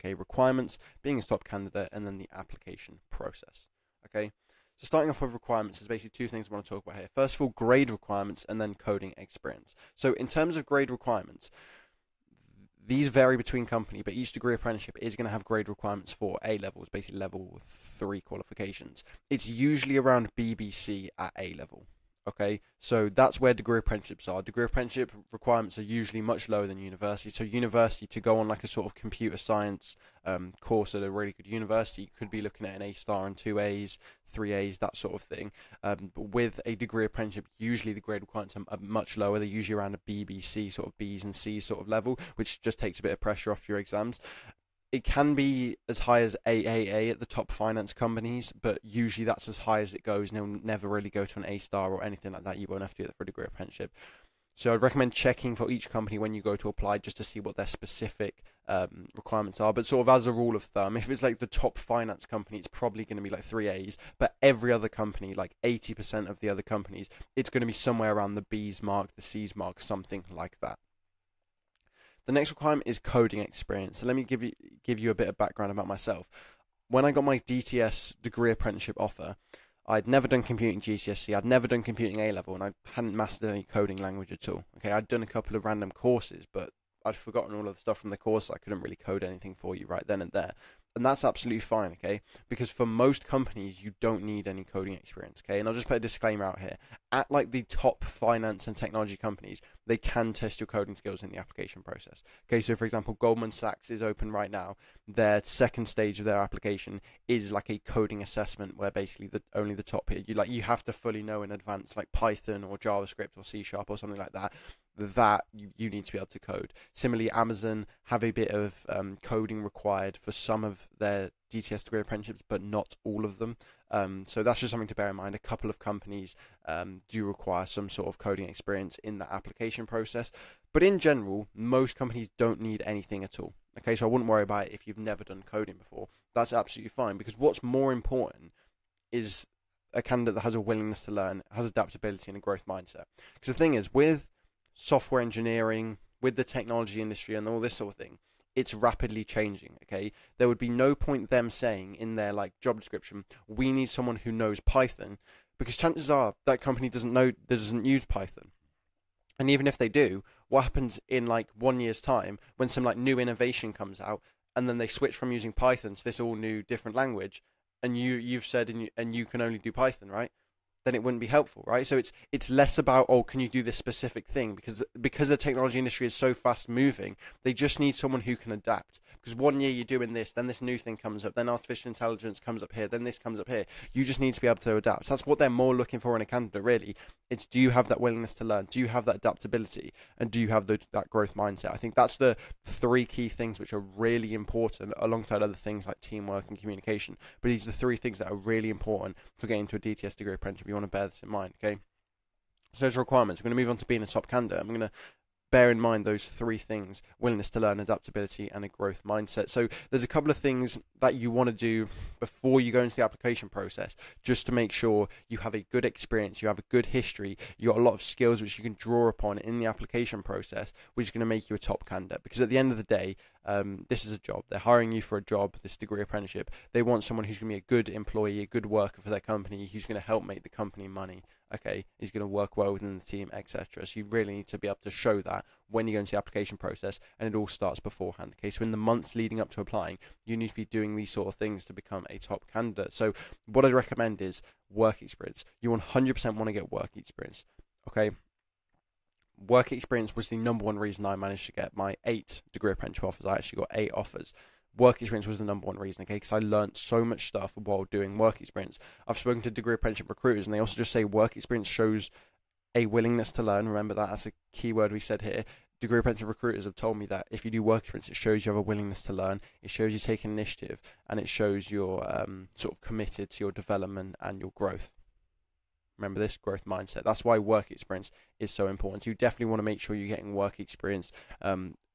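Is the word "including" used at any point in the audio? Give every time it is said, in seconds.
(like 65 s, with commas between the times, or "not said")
not said.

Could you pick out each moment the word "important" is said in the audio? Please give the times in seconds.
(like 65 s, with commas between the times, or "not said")
137 s, 194 s, 198 s, 278 s.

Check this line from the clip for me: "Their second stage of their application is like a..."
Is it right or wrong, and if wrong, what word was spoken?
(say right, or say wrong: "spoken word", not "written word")
right.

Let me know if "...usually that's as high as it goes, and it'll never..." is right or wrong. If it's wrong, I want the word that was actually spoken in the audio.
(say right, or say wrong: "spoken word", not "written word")
right.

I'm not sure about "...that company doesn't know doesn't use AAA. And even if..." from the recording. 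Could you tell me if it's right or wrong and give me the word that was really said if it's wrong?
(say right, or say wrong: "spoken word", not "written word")
wrong: "Python", not "AAA".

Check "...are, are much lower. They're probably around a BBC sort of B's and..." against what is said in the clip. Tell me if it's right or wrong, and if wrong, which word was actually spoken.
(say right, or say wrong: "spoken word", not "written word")
wrong: "usually", not "probably".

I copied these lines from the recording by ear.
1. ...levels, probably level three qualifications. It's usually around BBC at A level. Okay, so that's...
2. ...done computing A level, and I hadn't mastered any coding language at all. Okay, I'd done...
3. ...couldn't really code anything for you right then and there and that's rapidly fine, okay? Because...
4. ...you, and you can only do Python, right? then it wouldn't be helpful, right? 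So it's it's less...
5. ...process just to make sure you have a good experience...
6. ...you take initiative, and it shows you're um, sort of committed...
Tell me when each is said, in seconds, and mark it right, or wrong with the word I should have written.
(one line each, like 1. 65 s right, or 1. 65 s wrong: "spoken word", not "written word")
1. 16 s wrong: "basically", not "probably"
2. 81 s right
3. 88 s wrong: "absolutely", not "rapidly"
4. 168 s right
5. 213 s right
6. 269 s right.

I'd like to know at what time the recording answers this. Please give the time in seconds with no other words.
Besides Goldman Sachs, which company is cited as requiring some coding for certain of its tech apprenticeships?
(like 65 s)
117 s.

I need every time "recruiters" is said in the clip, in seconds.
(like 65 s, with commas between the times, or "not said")
260 s, 266 s.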